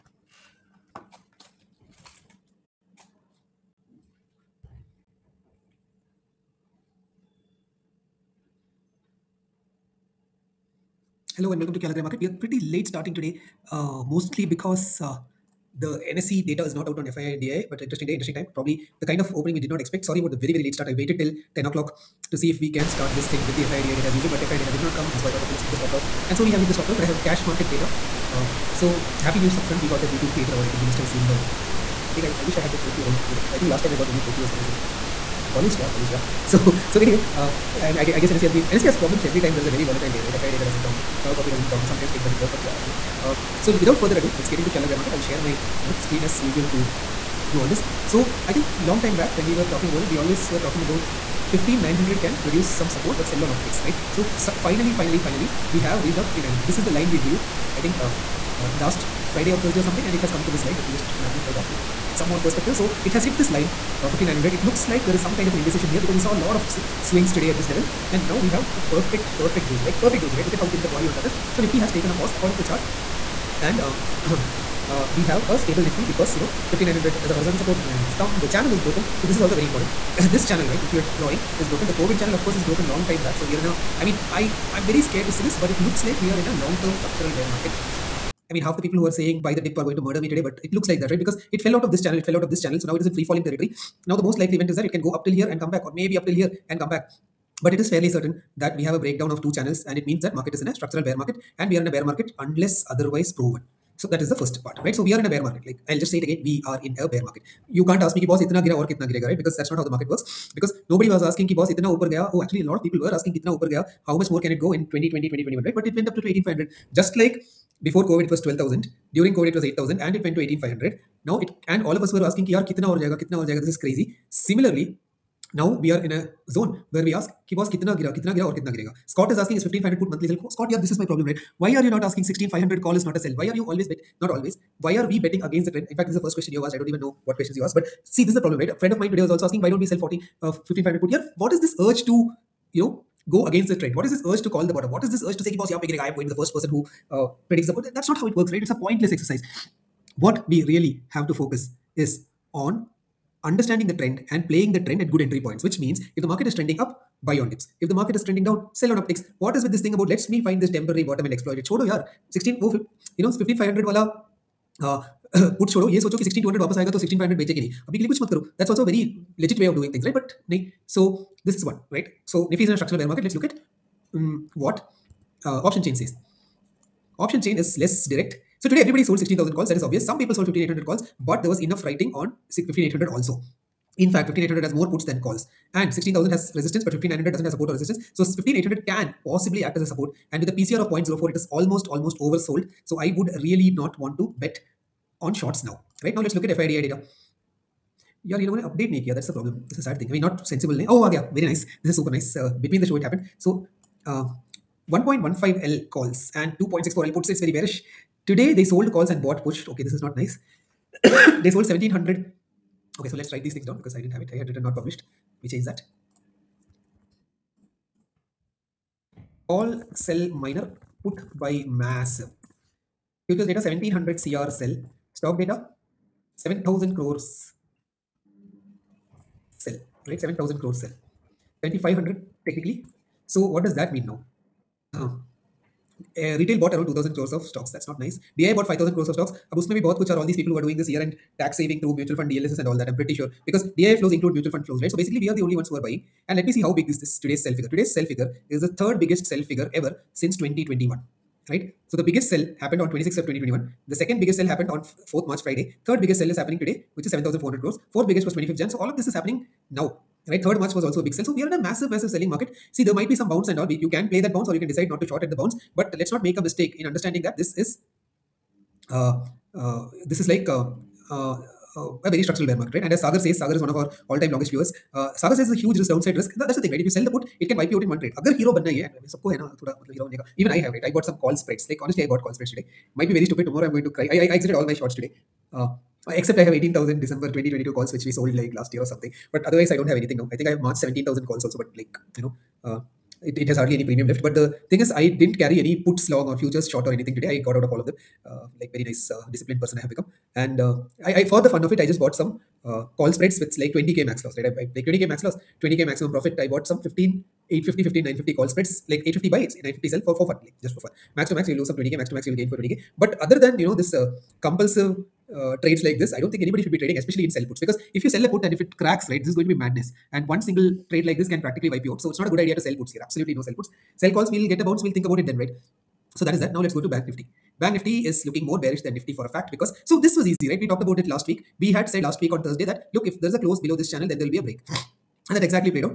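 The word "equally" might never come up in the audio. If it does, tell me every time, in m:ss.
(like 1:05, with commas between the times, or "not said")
not said.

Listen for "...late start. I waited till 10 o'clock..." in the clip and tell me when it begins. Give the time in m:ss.
0:20.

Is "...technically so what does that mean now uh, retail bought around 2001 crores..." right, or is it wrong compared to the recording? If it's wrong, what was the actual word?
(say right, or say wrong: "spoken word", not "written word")
wrong: "2000", not "2001".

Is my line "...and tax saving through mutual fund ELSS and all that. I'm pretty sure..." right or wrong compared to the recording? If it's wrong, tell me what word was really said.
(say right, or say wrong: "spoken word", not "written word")
right.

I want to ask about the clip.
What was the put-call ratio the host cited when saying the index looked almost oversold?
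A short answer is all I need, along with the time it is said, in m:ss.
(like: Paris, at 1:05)
0.04, at 3:10.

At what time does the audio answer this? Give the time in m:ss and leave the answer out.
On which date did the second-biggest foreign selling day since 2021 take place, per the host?
4:14.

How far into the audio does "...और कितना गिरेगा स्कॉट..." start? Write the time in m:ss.
2:08.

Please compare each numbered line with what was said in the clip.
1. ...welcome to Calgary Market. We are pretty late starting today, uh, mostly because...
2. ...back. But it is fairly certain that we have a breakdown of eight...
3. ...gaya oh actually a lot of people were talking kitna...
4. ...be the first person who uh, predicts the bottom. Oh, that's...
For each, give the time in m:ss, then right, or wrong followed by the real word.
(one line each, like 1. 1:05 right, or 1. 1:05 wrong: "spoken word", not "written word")
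1. 0:11 right
2. 1:36 wrong: "two", not "eight"
3. 1:52 wrong: "asking", not "talking"
4. 2:26 right.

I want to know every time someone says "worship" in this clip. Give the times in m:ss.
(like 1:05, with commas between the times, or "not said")
not said.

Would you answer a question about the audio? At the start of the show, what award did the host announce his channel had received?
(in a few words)
YouTube Creator Award.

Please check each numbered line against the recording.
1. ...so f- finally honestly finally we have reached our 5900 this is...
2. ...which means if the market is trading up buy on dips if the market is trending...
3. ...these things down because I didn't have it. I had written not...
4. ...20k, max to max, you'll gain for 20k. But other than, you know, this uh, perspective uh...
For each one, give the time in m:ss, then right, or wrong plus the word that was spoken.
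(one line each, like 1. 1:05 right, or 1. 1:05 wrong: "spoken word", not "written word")
1. 0:54 wrong: "finally", not "honestly"
2. 2:35 wrong: "trending", not "trading"
3. 3:33 right
4. 5:11 wrong: "compulsive", not "perspective".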